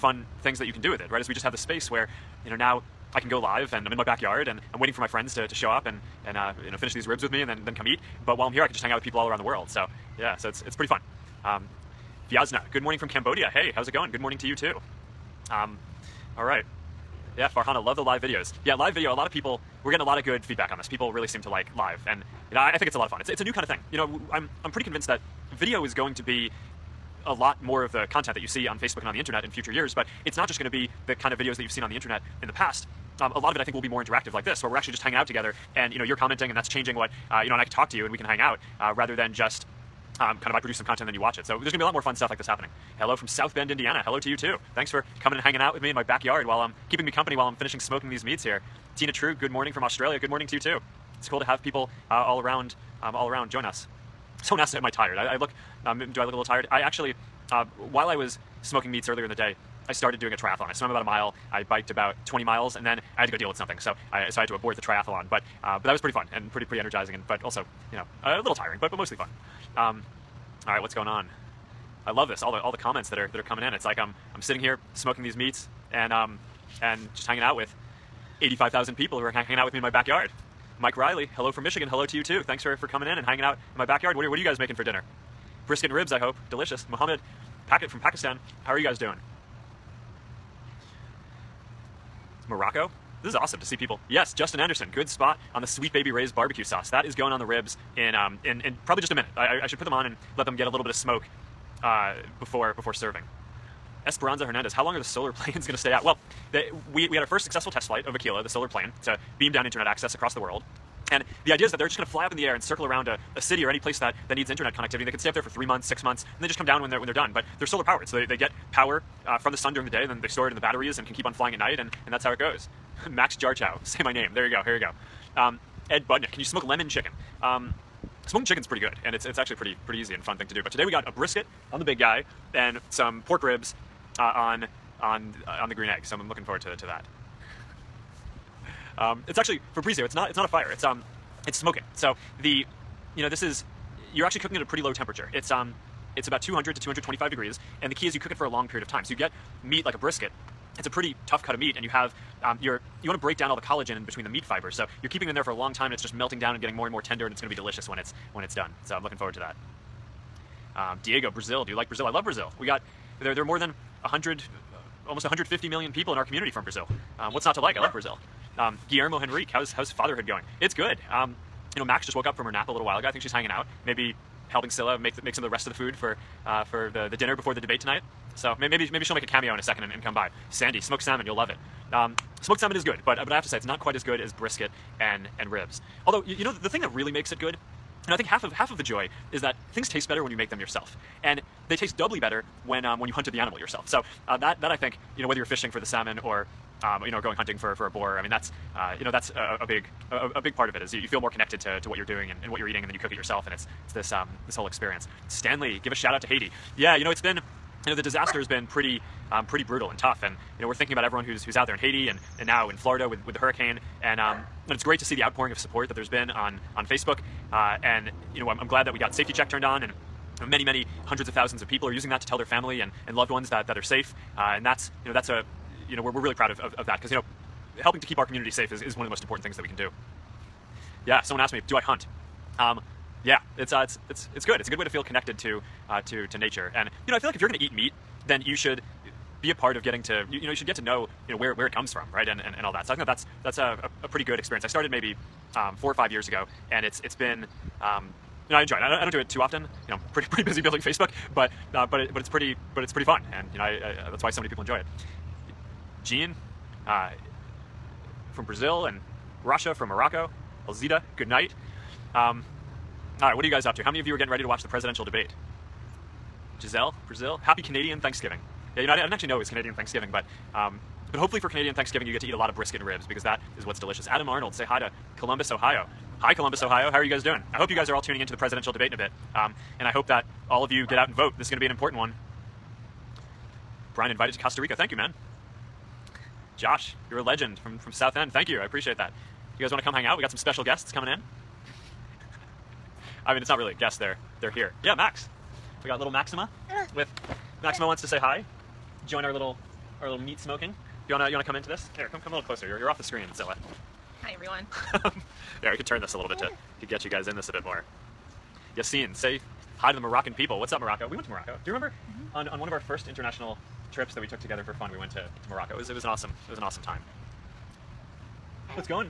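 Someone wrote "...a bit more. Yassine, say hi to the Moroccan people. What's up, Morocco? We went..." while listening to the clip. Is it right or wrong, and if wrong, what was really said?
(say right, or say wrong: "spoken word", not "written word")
right.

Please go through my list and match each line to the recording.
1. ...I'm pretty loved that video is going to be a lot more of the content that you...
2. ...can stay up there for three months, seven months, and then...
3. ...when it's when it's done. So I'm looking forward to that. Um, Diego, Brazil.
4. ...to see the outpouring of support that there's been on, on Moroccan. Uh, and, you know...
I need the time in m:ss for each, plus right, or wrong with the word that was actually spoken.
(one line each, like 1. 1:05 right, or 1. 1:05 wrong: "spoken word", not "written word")
1. 0:24 wrong: "convinced", not "loved"
2. 1:55 wrong: "six", not "seven"
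3. 2:37 right
4. 3:34 wrong: "Facebook", not "Moroccan".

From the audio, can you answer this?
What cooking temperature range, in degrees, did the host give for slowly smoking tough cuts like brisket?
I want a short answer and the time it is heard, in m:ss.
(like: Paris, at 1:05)
200 to 225 degrees, at 2:26.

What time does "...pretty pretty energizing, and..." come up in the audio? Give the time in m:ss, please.
1:06.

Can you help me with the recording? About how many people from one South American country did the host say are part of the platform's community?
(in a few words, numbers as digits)
150 million.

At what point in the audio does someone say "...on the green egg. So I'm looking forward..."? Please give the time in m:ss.
2:15.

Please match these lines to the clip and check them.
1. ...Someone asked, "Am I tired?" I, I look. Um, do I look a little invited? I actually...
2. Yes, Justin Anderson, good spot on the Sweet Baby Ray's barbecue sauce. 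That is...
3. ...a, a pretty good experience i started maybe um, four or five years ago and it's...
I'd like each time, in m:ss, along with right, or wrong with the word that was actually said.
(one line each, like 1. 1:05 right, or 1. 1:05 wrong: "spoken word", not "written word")
1. 0:54 wrong: "tired", not "invited"
2. 1:34 right
3. 4:04 right.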